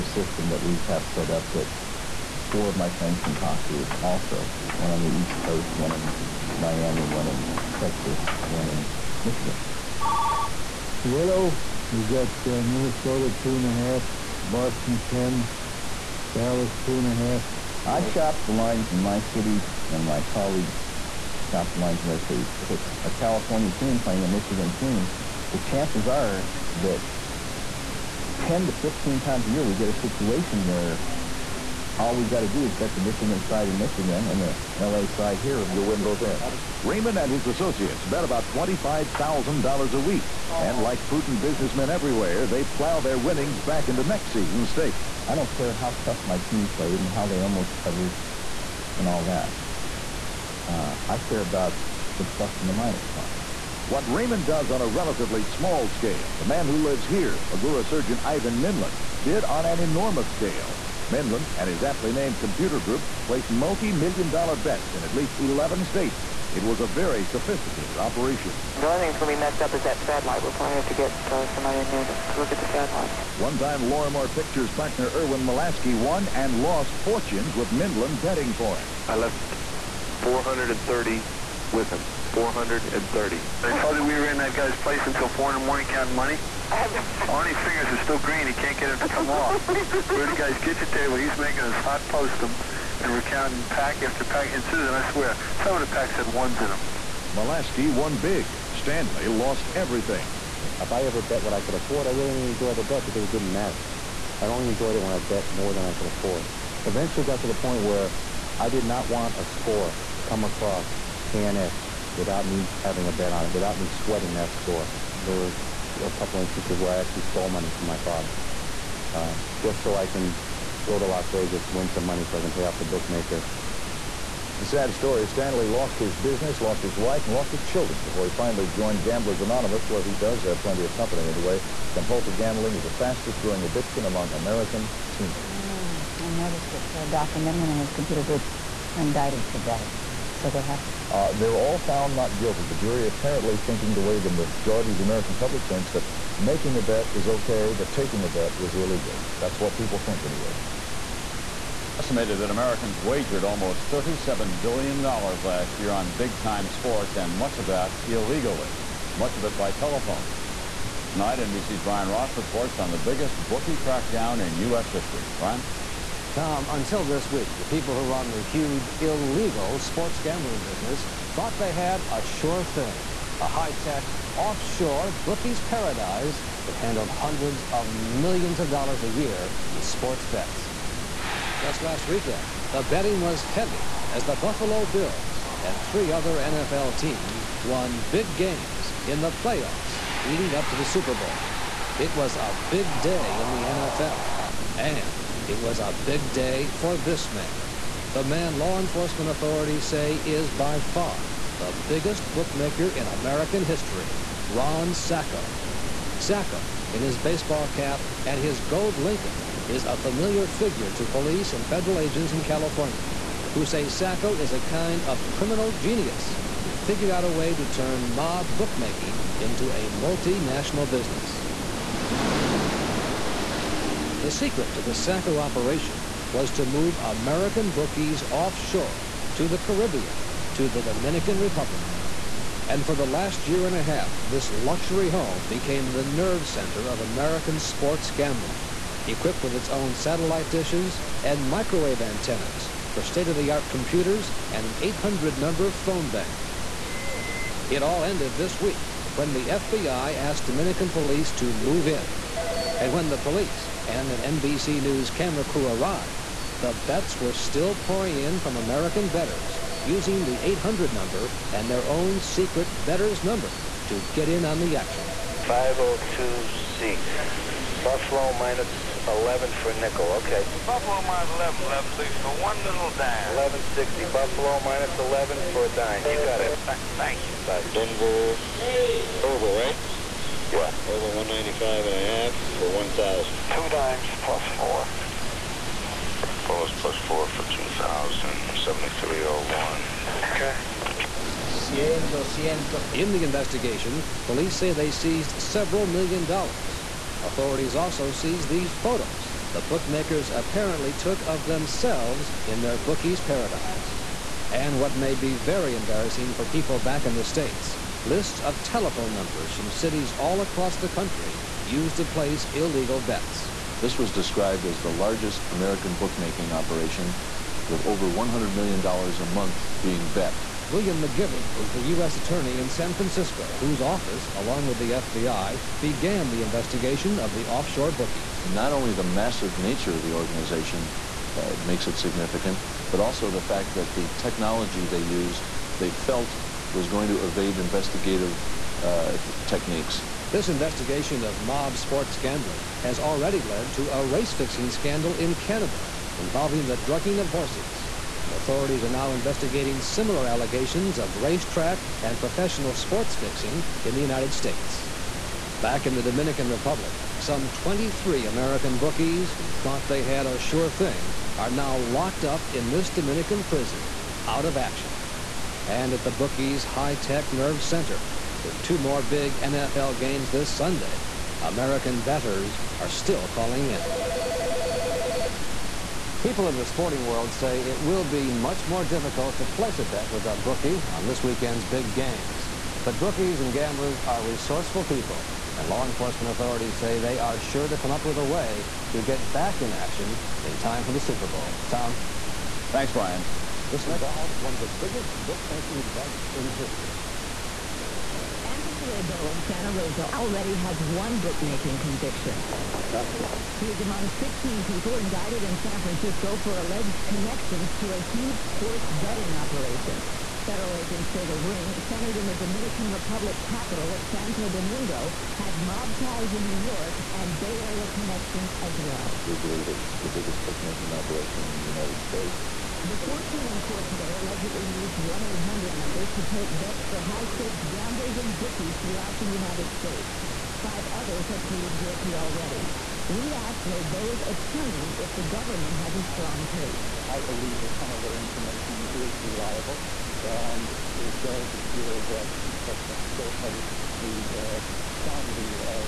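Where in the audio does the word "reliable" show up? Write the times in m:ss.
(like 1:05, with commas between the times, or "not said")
7:19.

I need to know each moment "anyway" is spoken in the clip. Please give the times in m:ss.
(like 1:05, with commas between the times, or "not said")
2:11, 2:30.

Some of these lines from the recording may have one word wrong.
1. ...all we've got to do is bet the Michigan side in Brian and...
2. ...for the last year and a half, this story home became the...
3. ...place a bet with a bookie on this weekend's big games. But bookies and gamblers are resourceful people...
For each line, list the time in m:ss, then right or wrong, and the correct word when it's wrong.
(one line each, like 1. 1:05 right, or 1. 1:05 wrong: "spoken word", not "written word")
1. 0:31 wrong: "Michigan", not "Brian"
2. 3:52 wrong: "luxury", not "story"
3. 6:19 right.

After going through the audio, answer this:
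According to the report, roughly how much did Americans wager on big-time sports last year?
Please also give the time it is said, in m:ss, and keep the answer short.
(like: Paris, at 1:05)
$37 billion, at 2:33.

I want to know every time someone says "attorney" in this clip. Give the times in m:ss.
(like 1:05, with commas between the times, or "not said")
5:22, 7:14.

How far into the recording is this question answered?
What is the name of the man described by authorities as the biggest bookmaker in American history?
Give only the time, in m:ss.
3:24.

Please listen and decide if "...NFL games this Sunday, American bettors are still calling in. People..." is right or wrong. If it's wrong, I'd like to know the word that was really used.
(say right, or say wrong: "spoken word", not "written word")
right.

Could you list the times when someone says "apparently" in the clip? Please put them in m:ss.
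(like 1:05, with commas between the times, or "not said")
2:23, 5:00.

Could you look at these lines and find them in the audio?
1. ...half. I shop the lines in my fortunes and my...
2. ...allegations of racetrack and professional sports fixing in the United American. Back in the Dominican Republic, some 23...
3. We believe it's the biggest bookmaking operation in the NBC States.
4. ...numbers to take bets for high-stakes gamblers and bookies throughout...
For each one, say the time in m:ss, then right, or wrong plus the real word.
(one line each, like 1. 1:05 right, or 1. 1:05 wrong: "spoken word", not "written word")
1. 0:17 wrong: "cities", not "fortunes"
2. 5:50 wrong: "States", not "American"
3. 6:59 wrong: "United", not "NBC"
4. 7:05 right.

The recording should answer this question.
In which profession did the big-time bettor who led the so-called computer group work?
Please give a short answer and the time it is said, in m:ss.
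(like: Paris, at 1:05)
Surgeon, at 0:57.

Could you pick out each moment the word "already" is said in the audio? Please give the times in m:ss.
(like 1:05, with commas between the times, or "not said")
5:42, 6:40, 7:12.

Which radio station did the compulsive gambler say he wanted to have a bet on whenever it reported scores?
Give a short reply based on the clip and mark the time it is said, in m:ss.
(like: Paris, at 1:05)
KNX, at 1:51.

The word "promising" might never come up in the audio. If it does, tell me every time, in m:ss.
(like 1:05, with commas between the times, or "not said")
not said.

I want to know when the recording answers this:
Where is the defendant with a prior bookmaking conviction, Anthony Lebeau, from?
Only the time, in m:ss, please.
6:39.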